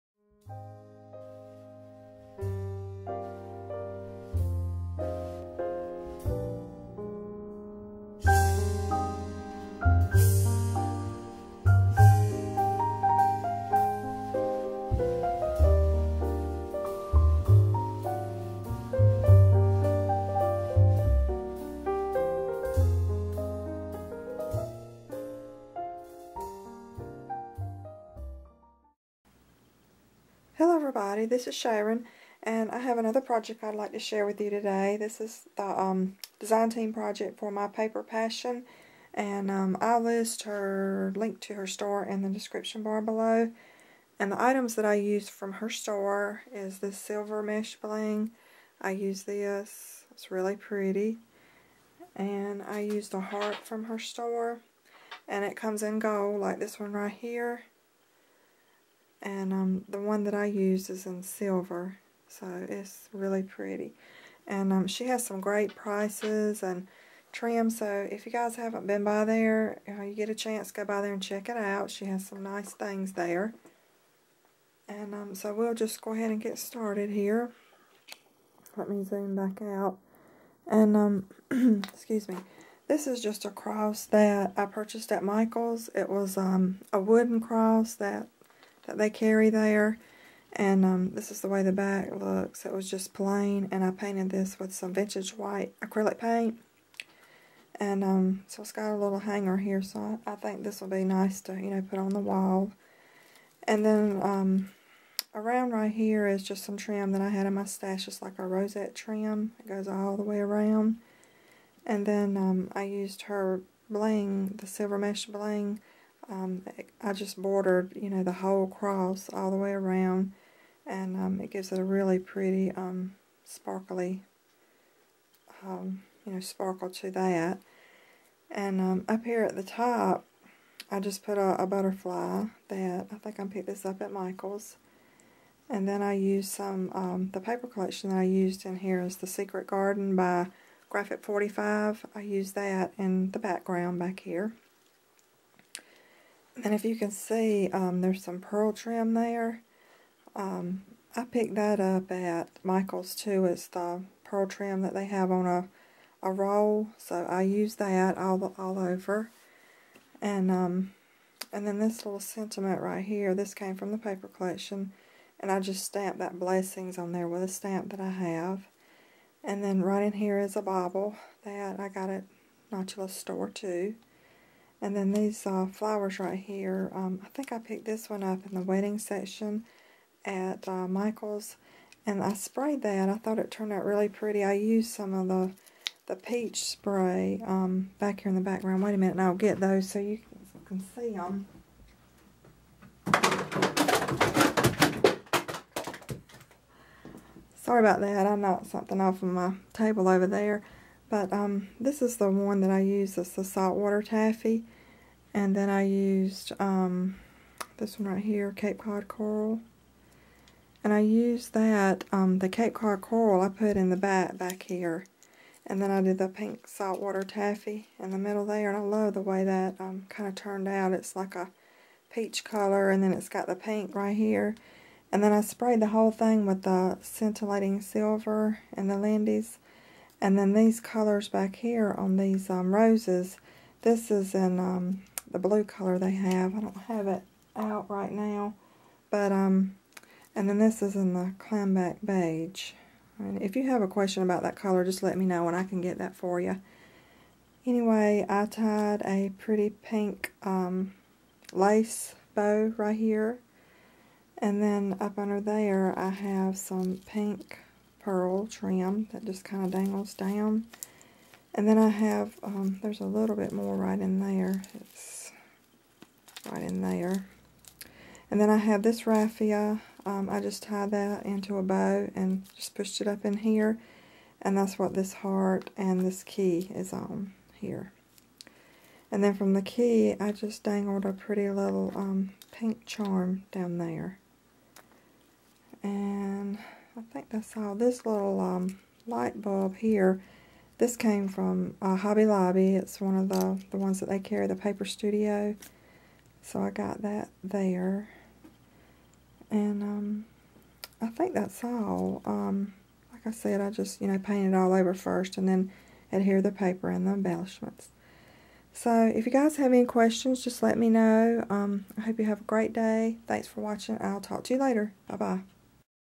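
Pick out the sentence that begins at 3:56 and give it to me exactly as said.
I don't have it out right now.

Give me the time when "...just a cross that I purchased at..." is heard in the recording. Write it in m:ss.
1:23.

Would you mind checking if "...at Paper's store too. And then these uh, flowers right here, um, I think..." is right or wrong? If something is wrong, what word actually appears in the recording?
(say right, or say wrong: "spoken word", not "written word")
wrong: "Notula", not "Paper".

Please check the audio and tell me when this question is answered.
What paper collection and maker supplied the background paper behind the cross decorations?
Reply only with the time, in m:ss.
2:19.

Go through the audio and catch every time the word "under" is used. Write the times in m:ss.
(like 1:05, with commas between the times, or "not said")
4:15.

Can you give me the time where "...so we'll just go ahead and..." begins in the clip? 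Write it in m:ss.
1:15.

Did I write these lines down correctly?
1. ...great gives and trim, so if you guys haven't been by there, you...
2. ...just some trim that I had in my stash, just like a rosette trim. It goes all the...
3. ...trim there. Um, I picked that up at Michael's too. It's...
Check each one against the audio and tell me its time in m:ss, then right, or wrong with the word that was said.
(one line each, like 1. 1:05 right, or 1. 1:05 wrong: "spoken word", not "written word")
1. 1:05 wrong: "prices", not "gives"
2. 1:46 right
3. 2:28 right.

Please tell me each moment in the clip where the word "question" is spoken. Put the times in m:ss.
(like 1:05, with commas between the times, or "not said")
4:03, 5:09.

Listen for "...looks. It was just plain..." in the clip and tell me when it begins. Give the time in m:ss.
1:32.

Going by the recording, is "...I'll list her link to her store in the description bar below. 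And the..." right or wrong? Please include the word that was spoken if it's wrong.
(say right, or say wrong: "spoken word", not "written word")
right.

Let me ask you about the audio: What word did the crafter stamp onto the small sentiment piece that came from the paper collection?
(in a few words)
blessings.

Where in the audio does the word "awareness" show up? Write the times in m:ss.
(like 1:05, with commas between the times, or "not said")
not said.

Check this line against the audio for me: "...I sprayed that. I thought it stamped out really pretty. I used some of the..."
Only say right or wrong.
wrong.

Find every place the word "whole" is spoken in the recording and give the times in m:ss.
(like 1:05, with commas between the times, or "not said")
1:58, 3:45.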